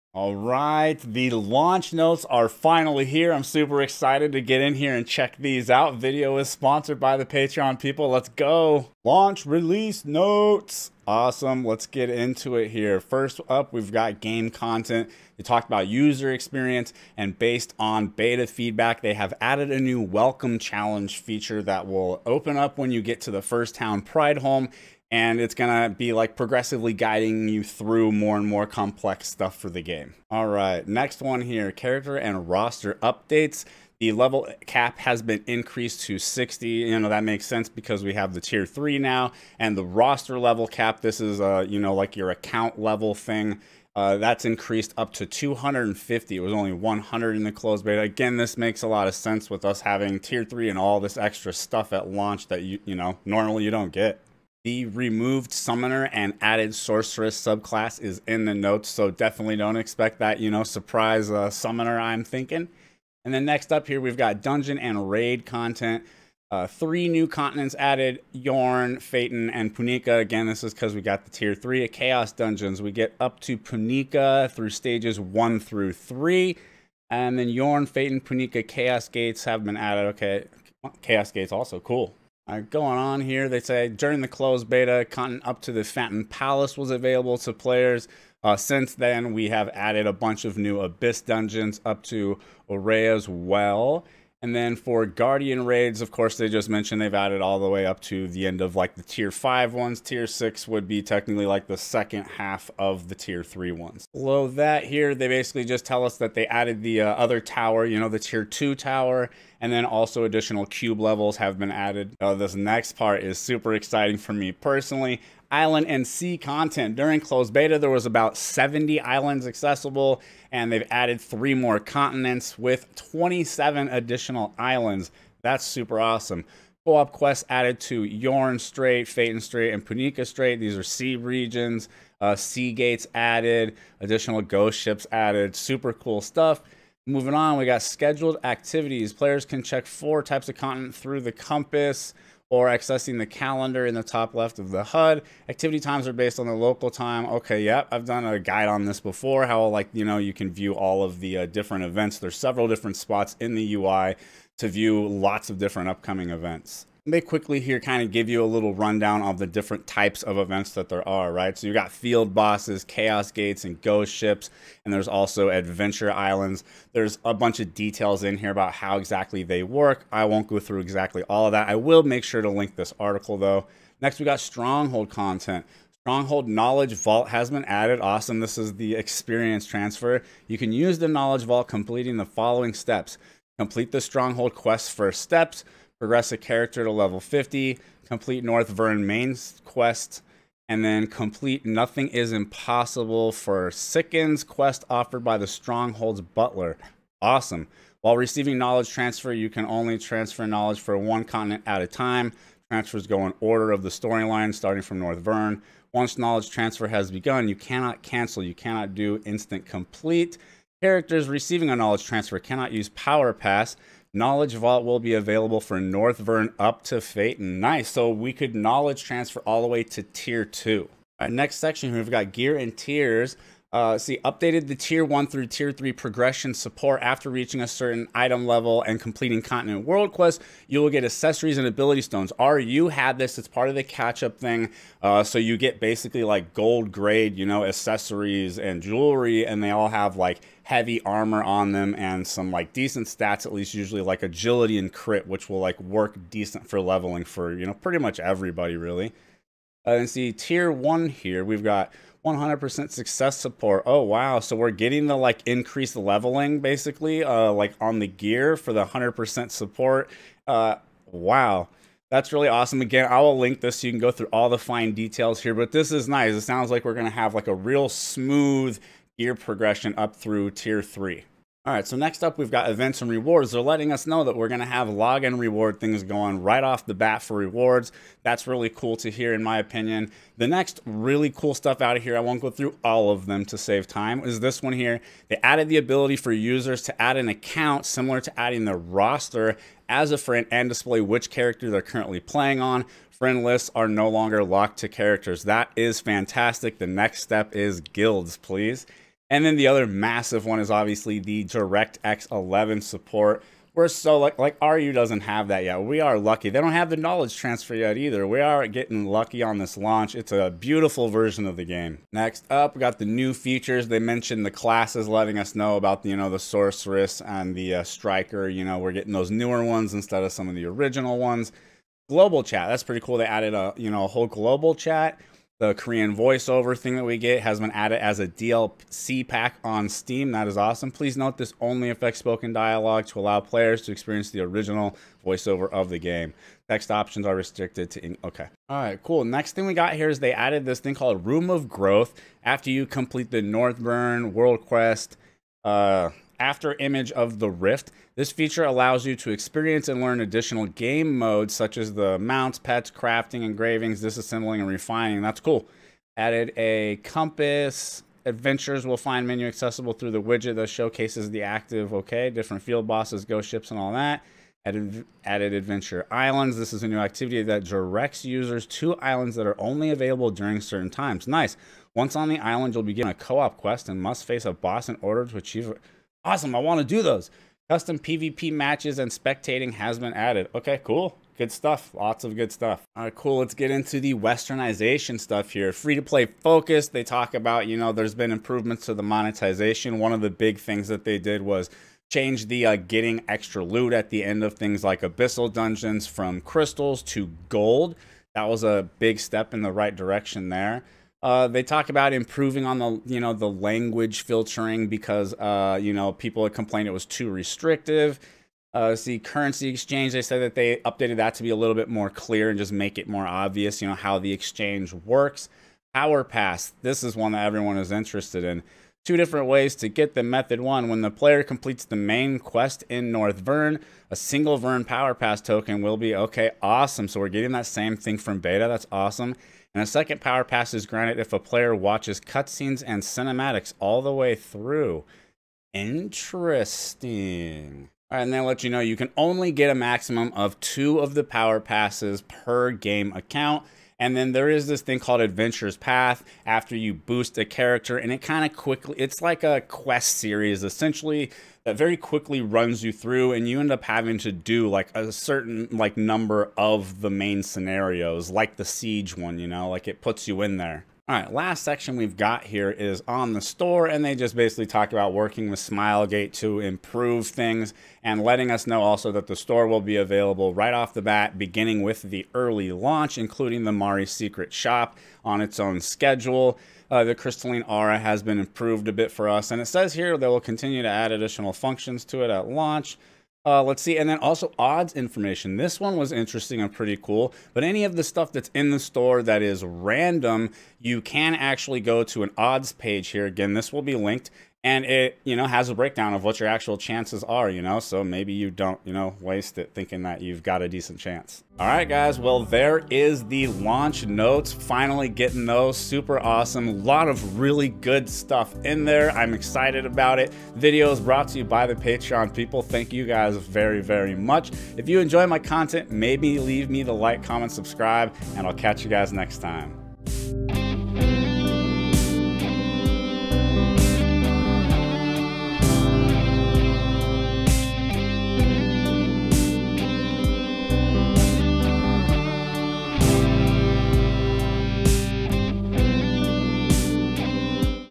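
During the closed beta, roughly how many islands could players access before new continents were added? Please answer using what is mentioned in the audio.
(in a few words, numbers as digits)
70.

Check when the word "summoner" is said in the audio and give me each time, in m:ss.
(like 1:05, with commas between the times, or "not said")
0:55, 1:01.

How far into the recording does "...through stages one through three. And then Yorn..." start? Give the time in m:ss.
1:14.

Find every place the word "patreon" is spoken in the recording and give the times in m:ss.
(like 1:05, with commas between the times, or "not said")
0:07, 8:31.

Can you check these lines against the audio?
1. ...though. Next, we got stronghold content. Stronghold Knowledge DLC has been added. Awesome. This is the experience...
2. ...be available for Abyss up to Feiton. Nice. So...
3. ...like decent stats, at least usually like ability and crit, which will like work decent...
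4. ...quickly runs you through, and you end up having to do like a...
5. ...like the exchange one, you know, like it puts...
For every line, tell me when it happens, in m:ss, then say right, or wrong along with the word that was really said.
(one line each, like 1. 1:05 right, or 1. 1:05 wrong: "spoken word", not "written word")
1. 2:53 wrong: "Vault", not "DLC"
2. 3:34 wrong: "Northvern", not "Abyss"
3. 4:02 wrong: "agility", not "ability"
4. 7:31 right
5. 7:38 wrong: "siege", not "exchange".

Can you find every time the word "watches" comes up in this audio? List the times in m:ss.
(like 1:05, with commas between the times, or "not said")
7:11.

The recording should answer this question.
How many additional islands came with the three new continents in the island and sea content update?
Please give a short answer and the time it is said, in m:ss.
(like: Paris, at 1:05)
27, at 2:02.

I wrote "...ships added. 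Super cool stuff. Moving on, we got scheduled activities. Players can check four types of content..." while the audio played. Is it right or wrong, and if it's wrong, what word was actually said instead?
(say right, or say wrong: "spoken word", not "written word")
right.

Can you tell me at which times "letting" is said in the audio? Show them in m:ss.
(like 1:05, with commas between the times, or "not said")
4:33, 5:15, 7:48.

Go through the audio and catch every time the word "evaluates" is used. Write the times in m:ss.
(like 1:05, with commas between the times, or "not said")
not said.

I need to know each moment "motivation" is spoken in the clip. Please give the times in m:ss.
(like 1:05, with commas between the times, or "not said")
not said.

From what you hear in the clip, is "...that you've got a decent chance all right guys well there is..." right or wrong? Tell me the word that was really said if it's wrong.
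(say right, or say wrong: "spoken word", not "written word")
right.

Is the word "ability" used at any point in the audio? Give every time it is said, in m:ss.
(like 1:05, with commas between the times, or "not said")
3:51, 4:45.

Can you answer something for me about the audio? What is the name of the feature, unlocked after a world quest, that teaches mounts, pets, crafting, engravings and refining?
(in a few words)
Room of Growth.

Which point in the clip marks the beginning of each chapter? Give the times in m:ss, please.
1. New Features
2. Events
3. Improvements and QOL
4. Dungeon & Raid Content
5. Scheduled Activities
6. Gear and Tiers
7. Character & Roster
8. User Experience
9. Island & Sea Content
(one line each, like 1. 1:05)
1. 5:12
2. 4:30
3. 4:40
4. 1:03
5. 2:17
6. 3:41
7. 0:30
8. 0:13
9. 1:52.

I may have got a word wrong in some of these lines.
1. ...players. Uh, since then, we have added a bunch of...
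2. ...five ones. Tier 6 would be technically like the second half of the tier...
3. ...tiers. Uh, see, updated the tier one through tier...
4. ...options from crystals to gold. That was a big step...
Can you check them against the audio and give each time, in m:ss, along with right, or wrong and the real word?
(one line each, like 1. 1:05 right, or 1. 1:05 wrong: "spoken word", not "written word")
1. 1:27 right
2. 1:39 right
3. 3:42 right
4. 6:35 wrong: "dungeons", not "options".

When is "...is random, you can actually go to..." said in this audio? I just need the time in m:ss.
8:09.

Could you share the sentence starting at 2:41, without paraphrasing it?
So you got field bosses, chaos gates, and ghost ships, and there's also adventure islands.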